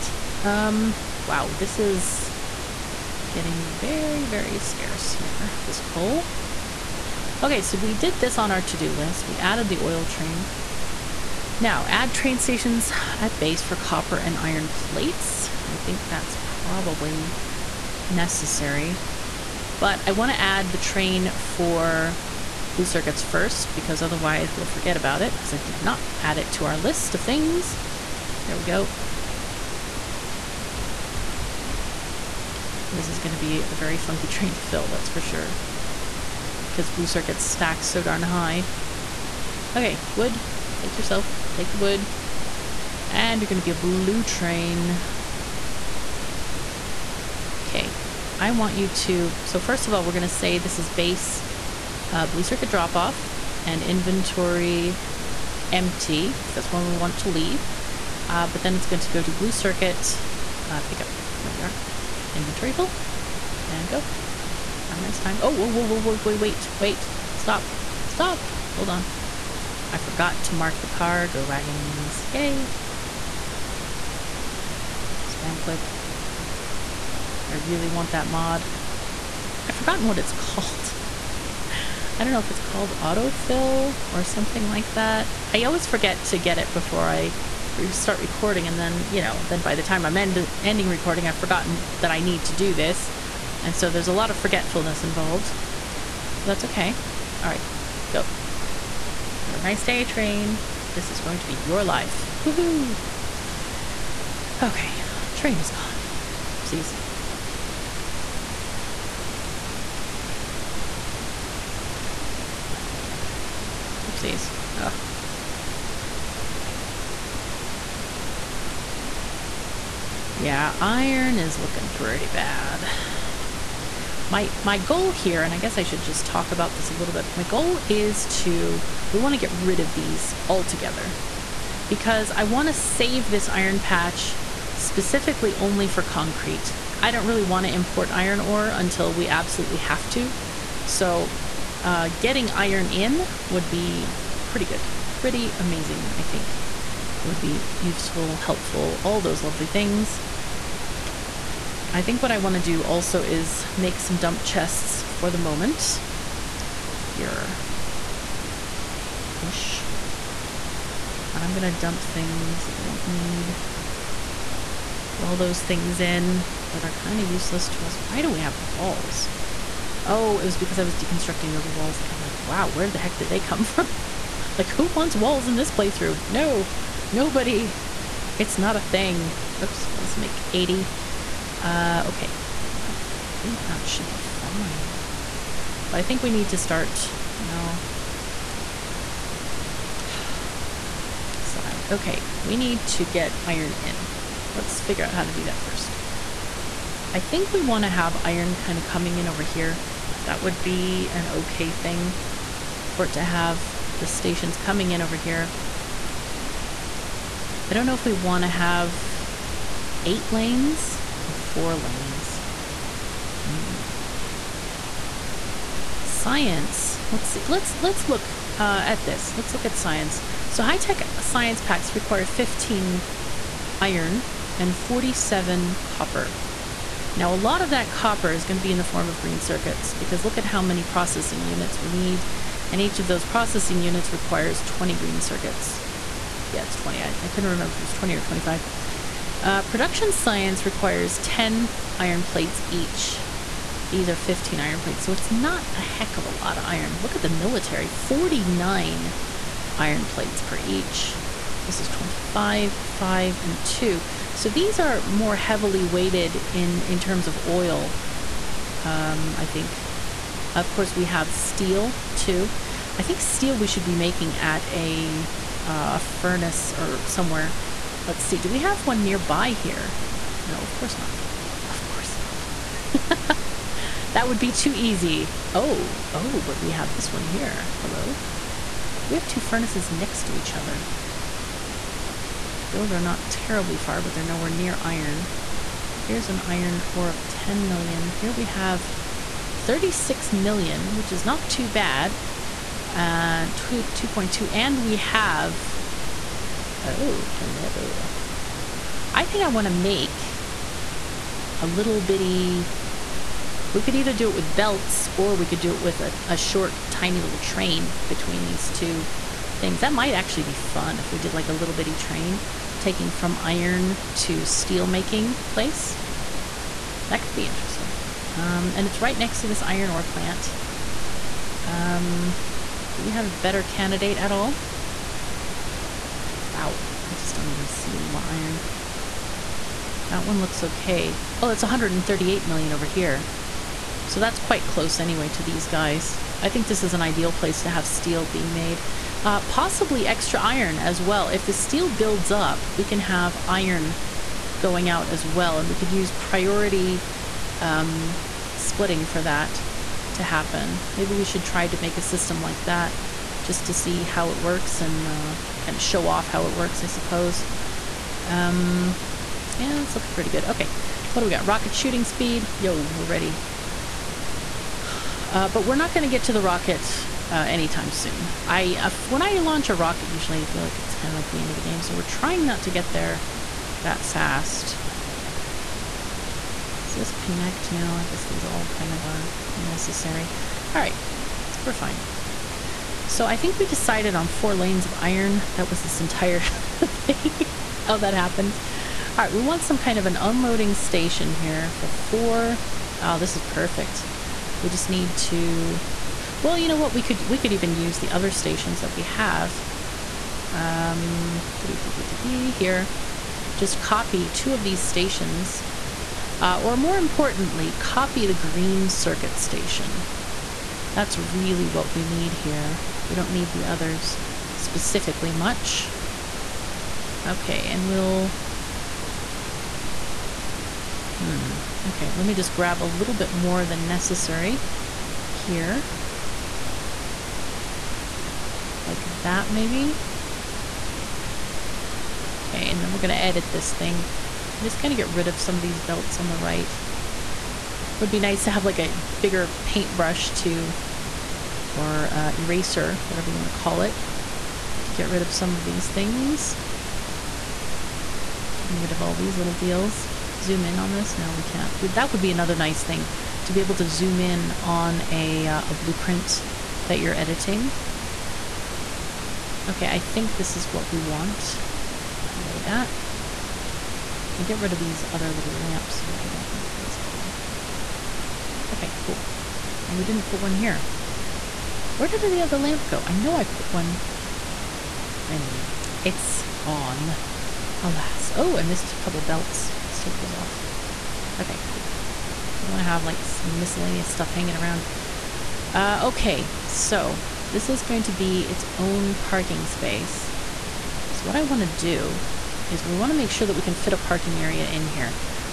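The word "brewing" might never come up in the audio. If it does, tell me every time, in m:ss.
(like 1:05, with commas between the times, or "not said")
not said.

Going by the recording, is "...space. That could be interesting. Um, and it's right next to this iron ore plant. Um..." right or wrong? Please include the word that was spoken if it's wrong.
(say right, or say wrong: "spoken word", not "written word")
wrong: "place", not "space".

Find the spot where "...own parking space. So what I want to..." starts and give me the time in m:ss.
8:08.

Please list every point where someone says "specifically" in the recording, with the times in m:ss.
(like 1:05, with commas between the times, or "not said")
2:14, 6:54.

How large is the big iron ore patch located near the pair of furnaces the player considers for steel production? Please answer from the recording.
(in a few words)
138 million.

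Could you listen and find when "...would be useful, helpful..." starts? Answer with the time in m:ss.
2:27.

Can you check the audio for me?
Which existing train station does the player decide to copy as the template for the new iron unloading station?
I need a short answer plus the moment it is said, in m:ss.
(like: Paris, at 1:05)
Green circuit station, at 6:48.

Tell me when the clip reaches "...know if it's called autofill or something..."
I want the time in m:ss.
1:22.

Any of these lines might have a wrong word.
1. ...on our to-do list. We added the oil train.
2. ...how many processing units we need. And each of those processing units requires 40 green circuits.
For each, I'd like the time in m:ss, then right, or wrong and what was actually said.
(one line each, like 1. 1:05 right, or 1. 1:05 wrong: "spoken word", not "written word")
1. 0:08 right
2. 3:50 wrong: "20", not "40".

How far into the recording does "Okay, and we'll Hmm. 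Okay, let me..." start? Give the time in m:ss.
6:57.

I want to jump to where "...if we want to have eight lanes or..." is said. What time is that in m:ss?
3:27.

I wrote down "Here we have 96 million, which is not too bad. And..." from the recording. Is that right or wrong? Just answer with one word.
wrong.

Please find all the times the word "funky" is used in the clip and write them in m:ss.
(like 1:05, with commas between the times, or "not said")
0:33.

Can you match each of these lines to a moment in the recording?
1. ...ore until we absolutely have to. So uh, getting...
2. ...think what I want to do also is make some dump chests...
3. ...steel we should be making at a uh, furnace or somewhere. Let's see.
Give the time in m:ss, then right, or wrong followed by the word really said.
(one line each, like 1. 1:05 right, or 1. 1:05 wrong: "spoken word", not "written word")
1. 2:18 right
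2. 2:32 right
3. 4:23 right.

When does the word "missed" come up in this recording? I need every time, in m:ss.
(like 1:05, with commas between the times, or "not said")
7:58.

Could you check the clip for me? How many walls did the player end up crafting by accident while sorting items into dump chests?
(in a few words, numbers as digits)
80.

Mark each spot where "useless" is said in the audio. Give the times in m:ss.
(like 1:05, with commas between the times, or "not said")
2:47.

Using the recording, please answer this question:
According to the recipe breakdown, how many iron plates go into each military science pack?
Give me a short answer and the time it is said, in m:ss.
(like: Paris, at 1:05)
49, at 4:07.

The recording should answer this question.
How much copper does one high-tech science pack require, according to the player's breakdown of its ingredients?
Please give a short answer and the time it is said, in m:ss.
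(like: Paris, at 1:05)
47, at 3:44.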